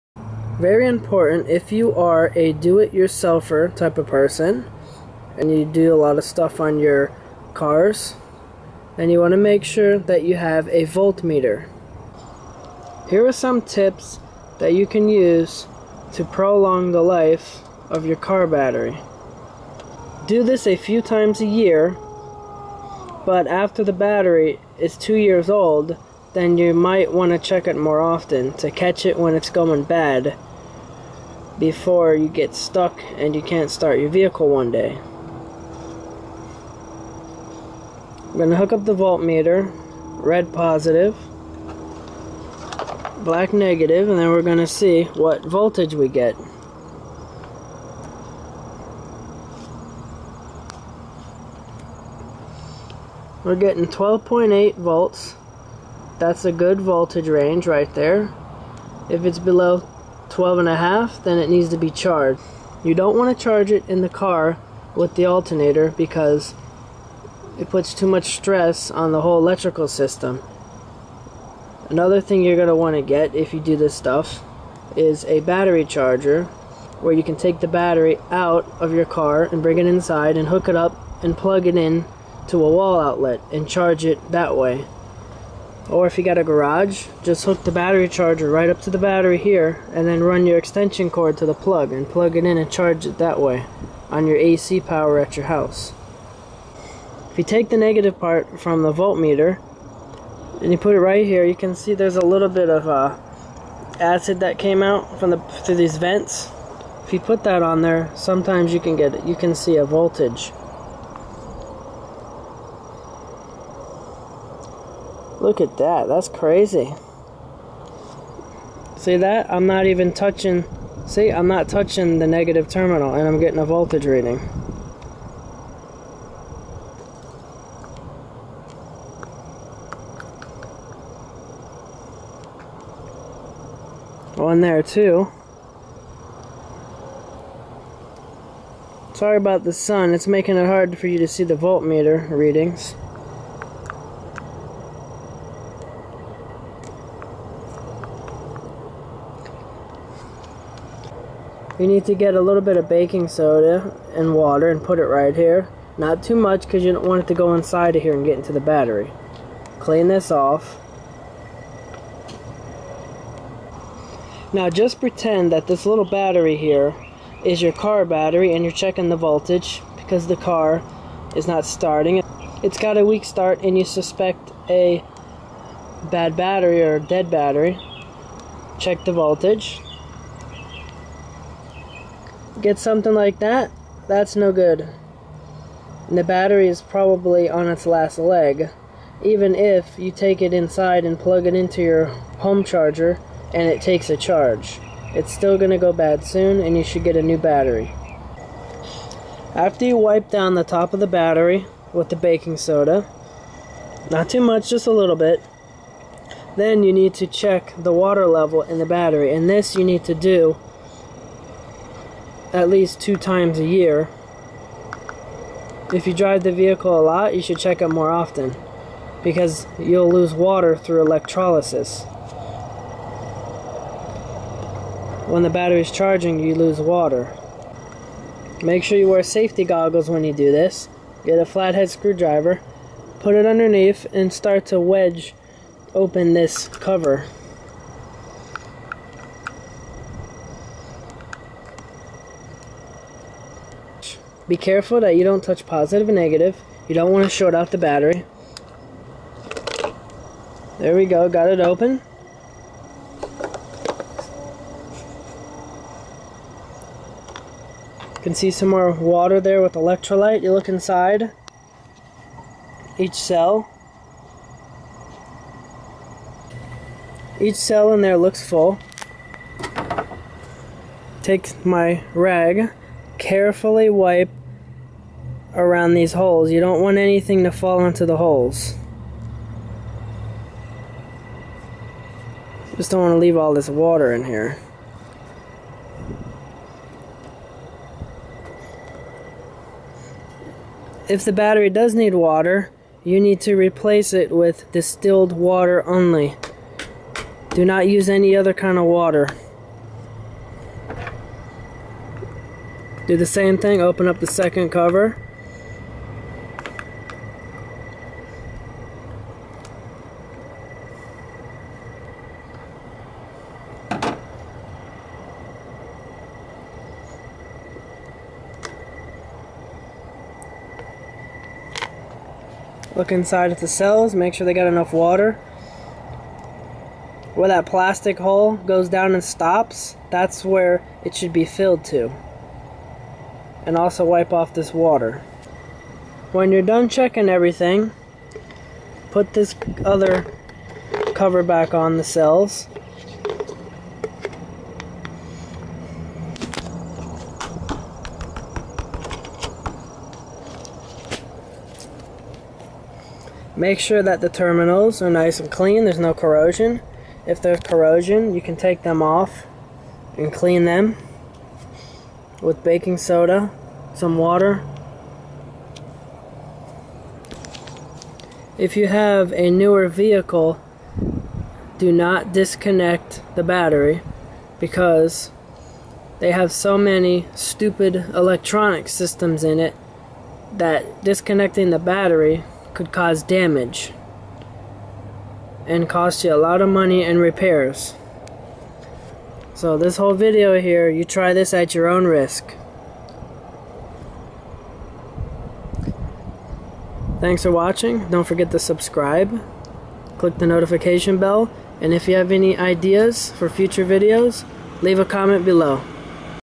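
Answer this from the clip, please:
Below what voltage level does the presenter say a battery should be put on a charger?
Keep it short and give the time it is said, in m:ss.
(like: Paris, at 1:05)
12.5, at 1:00.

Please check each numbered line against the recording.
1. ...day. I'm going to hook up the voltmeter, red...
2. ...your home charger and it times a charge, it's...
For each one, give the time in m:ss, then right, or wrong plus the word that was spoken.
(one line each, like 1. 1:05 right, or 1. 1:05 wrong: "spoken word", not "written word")
1. 0:34 right
2. 3:11 wrong: "takes", not "times".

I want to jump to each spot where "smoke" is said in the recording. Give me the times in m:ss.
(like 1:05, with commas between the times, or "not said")
not said.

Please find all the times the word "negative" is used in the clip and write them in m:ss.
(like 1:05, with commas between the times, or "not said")
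0:43, 1:37, 2:02, 4:06.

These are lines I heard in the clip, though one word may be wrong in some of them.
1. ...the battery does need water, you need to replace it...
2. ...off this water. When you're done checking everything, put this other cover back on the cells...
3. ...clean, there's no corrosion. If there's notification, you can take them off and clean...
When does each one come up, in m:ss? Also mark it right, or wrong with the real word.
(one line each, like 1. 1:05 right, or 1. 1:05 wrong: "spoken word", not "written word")
1. 4:51 right
2. 5:34 right
3. 5:55 wrong: "corrosion", not "notification".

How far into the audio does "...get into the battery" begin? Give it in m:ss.
2:38.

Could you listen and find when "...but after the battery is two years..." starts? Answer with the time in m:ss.
0:23.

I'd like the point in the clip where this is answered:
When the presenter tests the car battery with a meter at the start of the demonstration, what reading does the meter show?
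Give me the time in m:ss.
0:53.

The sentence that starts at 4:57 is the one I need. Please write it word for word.
Do not use any other kind of water.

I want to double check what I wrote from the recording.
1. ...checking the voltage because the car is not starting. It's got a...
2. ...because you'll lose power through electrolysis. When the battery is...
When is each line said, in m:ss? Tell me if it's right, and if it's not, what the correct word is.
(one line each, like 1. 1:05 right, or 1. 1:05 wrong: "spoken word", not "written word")
1. 2:48 right
2. 3:39 wrong: "water", not "power".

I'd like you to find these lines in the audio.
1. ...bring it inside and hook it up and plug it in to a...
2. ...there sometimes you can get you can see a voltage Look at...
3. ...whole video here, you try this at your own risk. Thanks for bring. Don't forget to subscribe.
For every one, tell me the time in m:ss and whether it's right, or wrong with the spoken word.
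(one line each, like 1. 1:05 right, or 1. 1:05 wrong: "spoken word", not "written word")
1. 1:19 right
2. 1:47 right
3. 6:29 wrong: "watching", not "bring".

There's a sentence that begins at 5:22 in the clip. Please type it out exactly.
Look inside at the cells, make sure they got enough water.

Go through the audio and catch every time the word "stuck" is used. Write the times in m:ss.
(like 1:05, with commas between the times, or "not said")
0:32.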